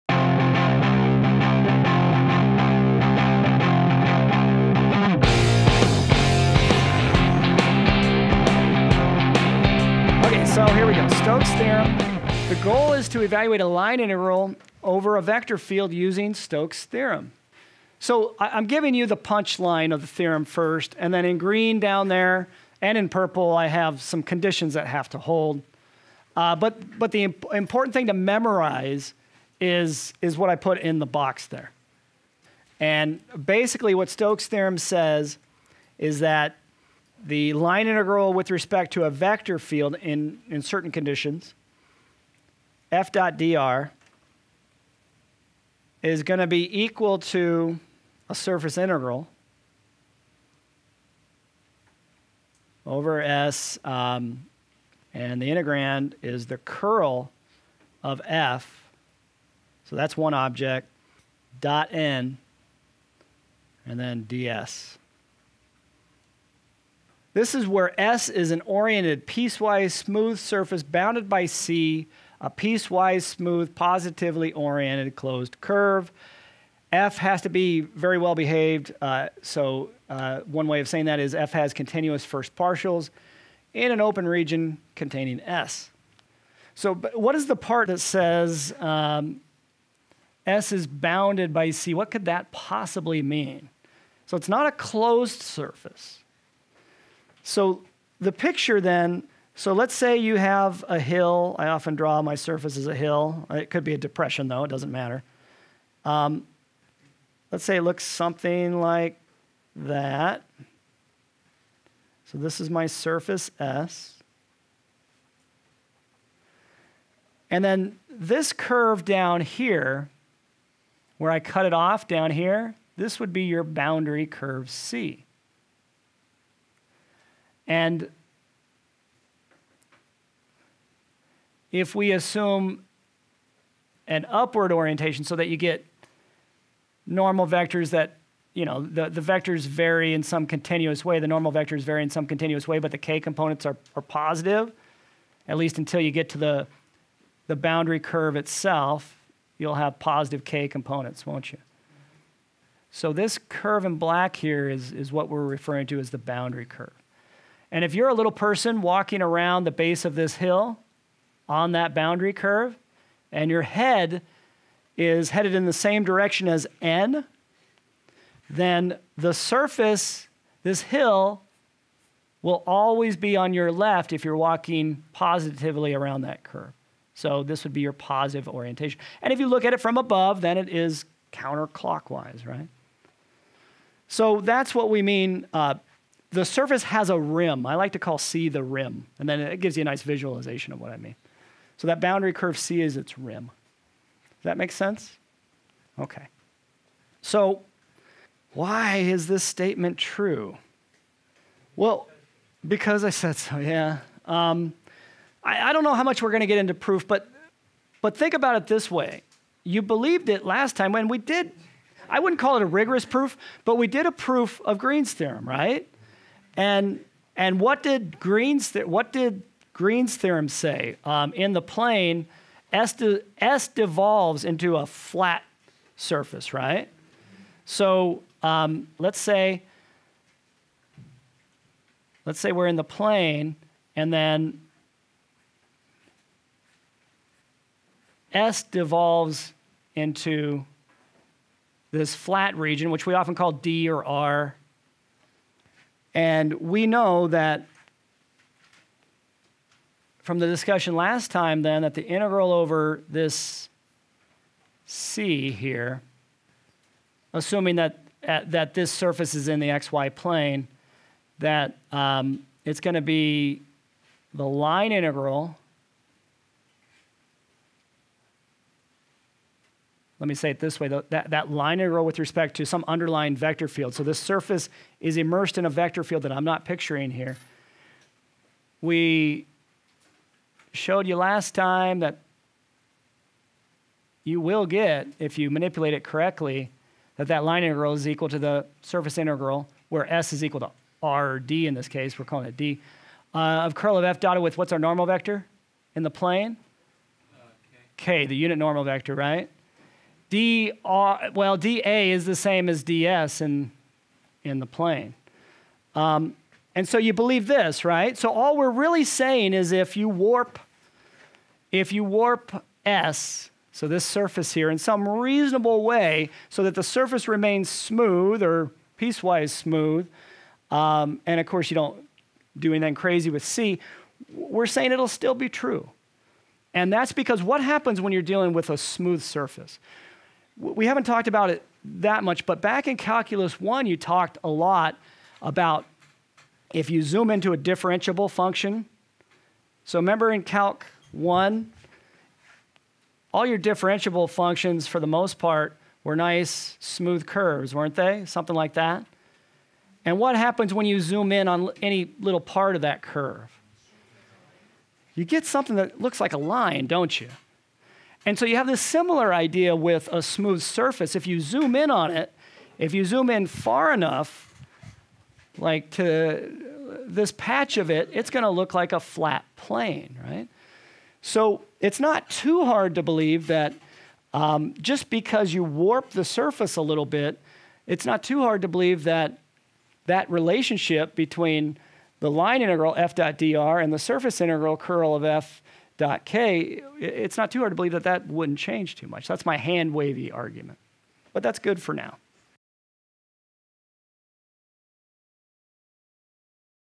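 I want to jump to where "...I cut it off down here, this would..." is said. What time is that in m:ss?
2:01.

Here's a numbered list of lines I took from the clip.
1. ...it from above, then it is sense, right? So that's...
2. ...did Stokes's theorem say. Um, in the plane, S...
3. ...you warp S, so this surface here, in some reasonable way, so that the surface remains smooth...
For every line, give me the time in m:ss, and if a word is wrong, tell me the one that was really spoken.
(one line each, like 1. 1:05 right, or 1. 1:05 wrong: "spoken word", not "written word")
1. 2:59 wrong: "counterclockwise", not "sense"
2. 3:39 wrong: "Green", not "Stokes"
3. 5:11 right.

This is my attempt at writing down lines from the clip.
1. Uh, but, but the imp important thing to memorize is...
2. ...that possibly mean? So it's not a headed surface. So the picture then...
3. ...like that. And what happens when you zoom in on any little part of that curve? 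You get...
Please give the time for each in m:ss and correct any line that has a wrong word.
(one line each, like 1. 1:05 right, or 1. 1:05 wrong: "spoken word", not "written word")
1. 0:26 right
2. 1:32 wrong: "closed", not "headed"
3. 5:48 right.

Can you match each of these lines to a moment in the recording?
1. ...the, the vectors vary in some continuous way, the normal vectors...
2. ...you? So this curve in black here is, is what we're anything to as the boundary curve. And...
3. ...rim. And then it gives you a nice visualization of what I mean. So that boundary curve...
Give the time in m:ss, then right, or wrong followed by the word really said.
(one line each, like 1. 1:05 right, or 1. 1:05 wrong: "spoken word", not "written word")
1. 2:18 right
2. 2:31 wrong: "referring", not "anything"
3. 3:08 right.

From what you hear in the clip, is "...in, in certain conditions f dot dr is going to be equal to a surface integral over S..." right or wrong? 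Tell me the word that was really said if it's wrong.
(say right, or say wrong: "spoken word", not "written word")
right.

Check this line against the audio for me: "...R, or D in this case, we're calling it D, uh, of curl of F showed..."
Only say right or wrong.
wrong.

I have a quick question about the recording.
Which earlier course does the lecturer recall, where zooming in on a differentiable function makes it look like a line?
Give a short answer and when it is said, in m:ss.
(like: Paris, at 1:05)
Calculus 1, at 5:32.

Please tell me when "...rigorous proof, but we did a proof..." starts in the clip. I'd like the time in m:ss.
3:32.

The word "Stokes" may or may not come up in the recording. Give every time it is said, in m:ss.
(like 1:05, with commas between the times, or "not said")
0:16, 0:34.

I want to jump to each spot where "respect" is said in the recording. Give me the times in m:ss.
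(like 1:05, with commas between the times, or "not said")
0:38, 4:32.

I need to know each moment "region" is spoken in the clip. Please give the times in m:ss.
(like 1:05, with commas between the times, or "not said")
1:24, 4:02.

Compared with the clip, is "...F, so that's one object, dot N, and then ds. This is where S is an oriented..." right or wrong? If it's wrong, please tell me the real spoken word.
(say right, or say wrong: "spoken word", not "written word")
right.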